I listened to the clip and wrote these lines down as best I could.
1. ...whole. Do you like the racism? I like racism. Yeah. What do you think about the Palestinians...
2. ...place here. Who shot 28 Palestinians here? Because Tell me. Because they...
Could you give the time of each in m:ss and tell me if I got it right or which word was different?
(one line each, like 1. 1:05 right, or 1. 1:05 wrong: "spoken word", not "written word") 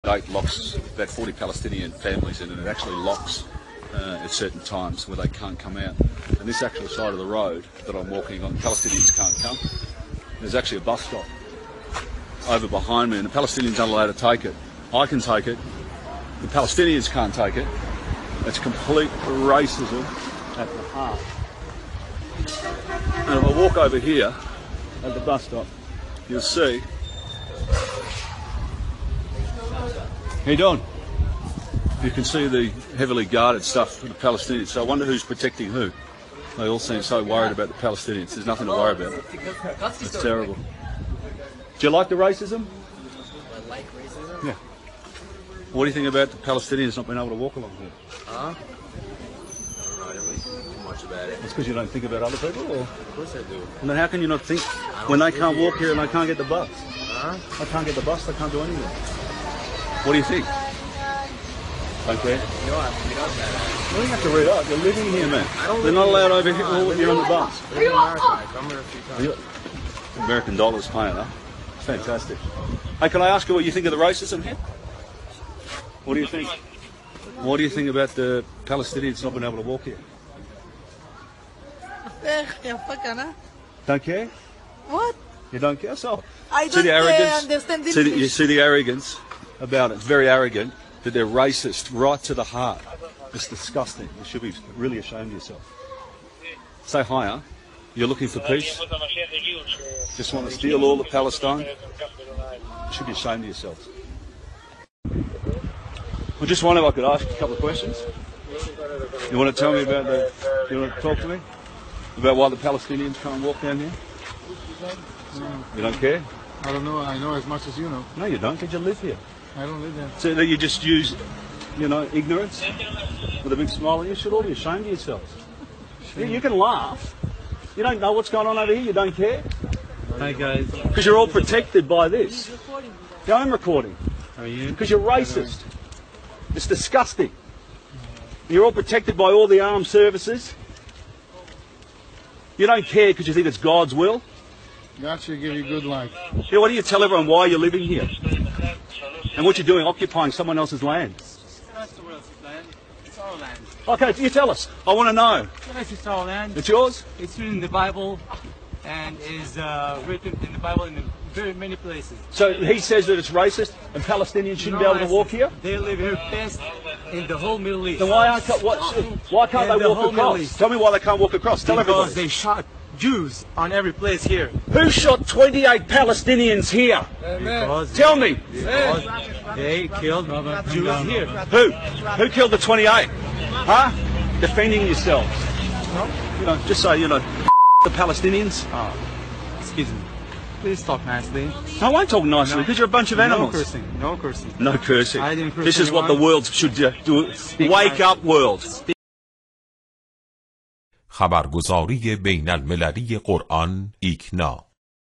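1. 0:40 wrong: "terrible", not "whole"
2. 2:53 right.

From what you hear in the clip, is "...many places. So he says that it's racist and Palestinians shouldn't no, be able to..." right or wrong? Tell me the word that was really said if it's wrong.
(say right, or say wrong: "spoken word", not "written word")
right.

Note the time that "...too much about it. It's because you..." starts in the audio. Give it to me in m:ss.
0:50.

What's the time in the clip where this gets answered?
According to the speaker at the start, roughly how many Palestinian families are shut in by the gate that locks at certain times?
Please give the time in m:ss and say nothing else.
0:01.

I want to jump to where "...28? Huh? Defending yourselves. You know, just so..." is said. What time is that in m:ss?
3:02.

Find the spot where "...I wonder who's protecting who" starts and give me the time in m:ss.
0:34.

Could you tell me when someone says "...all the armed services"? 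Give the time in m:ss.
2:19.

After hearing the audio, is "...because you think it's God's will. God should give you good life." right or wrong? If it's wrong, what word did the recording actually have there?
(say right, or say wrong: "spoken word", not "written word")
right.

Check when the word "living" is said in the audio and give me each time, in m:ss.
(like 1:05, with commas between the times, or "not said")
1:04, 2:27.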